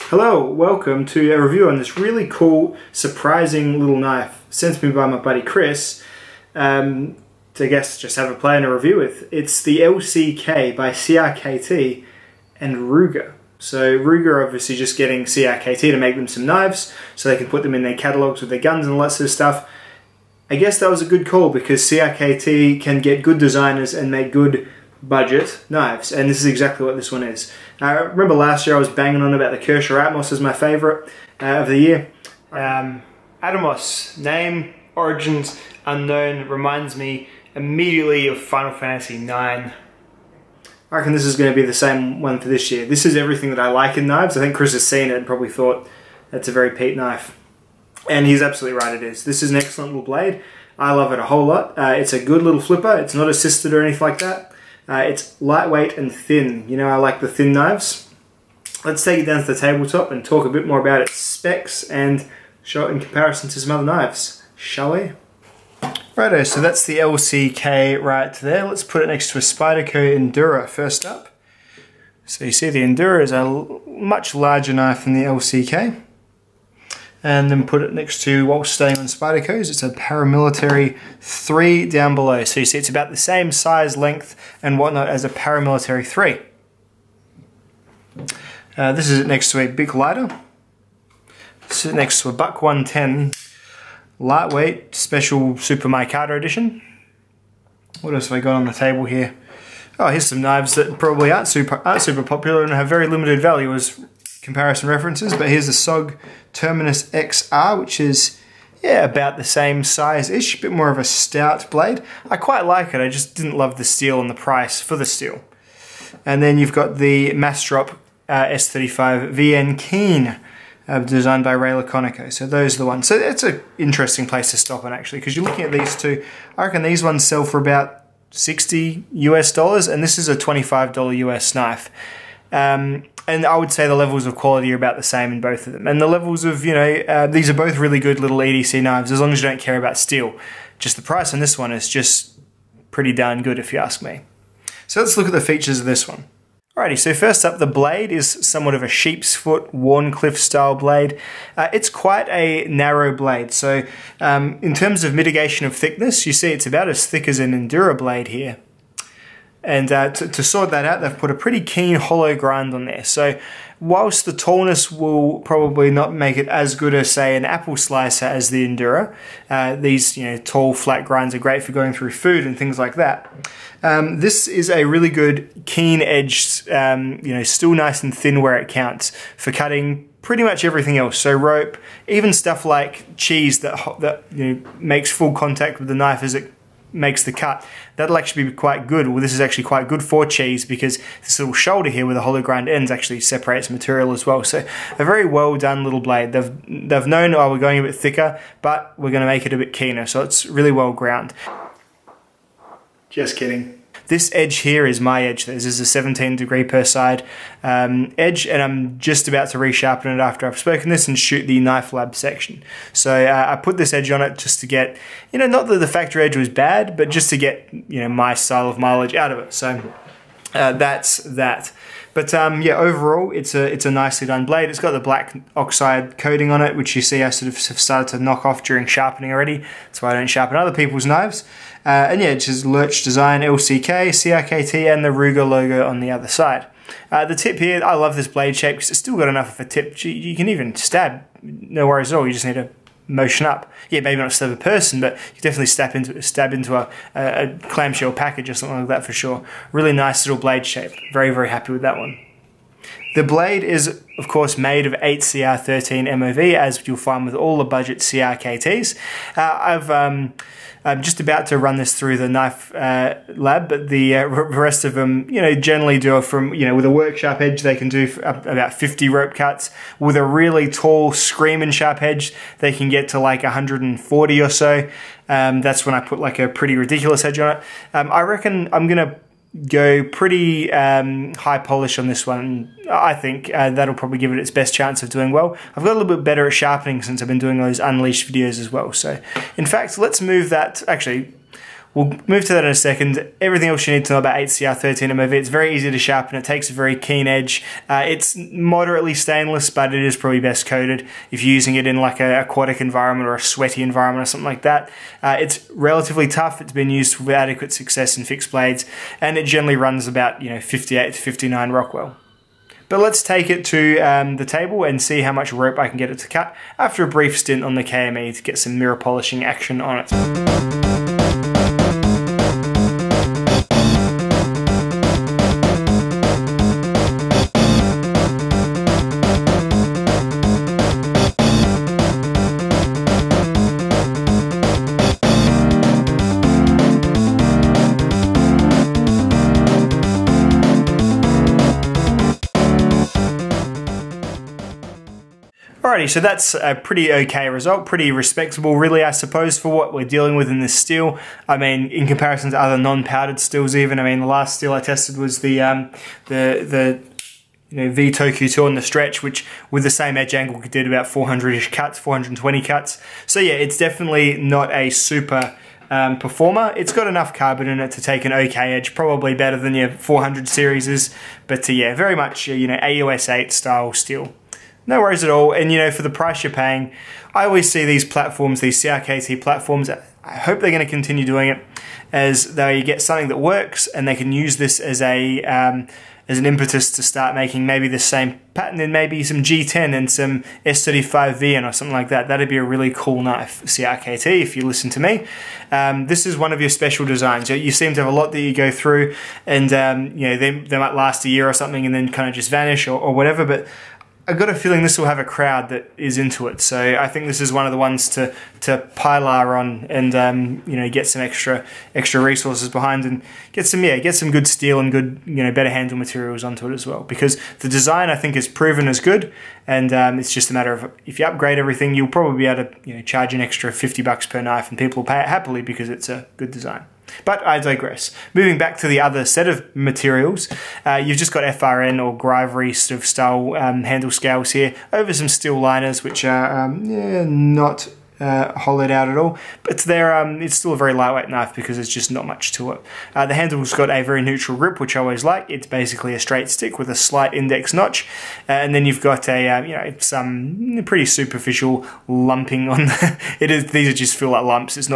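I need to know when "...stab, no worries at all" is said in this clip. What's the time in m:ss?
4:00.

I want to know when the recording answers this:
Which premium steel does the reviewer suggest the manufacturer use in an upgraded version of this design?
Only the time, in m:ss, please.
6:30.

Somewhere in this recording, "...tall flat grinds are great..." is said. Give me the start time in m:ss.
2:50.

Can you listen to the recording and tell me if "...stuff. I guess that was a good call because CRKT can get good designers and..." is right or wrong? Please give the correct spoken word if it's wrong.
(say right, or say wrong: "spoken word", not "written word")
right.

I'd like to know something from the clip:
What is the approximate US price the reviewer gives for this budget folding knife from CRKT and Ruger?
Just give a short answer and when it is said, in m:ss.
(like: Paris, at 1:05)
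$25, at 2:10.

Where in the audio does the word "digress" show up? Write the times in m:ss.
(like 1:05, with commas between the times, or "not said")
7:07.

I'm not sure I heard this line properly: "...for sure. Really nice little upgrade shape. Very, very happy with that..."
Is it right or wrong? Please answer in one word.
wrong.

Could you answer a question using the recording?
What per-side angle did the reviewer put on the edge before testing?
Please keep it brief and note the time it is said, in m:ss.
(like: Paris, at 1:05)
17 degrees, at 3:25.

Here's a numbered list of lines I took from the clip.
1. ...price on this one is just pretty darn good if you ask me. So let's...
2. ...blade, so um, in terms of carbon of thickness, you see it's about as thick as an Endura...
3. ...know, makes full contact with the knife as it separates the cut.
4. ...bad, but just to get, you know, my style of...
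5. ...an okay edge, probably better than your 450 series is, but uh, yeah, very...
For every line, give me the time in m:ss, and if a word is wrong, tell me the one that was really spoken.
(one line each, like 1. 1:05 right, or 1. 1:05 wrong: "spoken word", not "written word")
1. 2:21 right
2. 2:33 wrong: "mitigation", not "carbon"
3. 3:04 wrong: "makes", not "separates"
4. 3:36 right
5. 6:08 wrong: "400", not "450".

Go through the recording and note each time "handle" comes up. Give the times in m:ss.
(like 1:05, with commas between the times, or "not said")
6:55, 7:13, 7:23.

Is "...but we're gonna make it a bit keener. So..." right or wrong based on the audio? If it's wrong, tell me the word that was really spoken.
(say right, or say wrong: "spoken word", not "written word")
right.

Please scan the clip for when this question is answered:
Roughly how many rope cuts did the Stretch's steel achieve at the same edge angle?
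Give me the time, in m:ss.
6:01.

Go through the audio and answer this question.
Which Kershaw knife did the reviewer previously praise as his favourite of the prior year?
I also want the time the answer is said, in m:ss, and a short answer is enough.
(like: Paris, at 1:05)
Atmos, at 0:29.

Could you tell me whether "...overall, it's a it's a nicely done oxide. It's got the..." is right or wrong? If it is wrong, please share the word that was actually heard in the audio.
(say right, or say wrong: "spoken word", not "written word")
wrong: "blade", not "oxide".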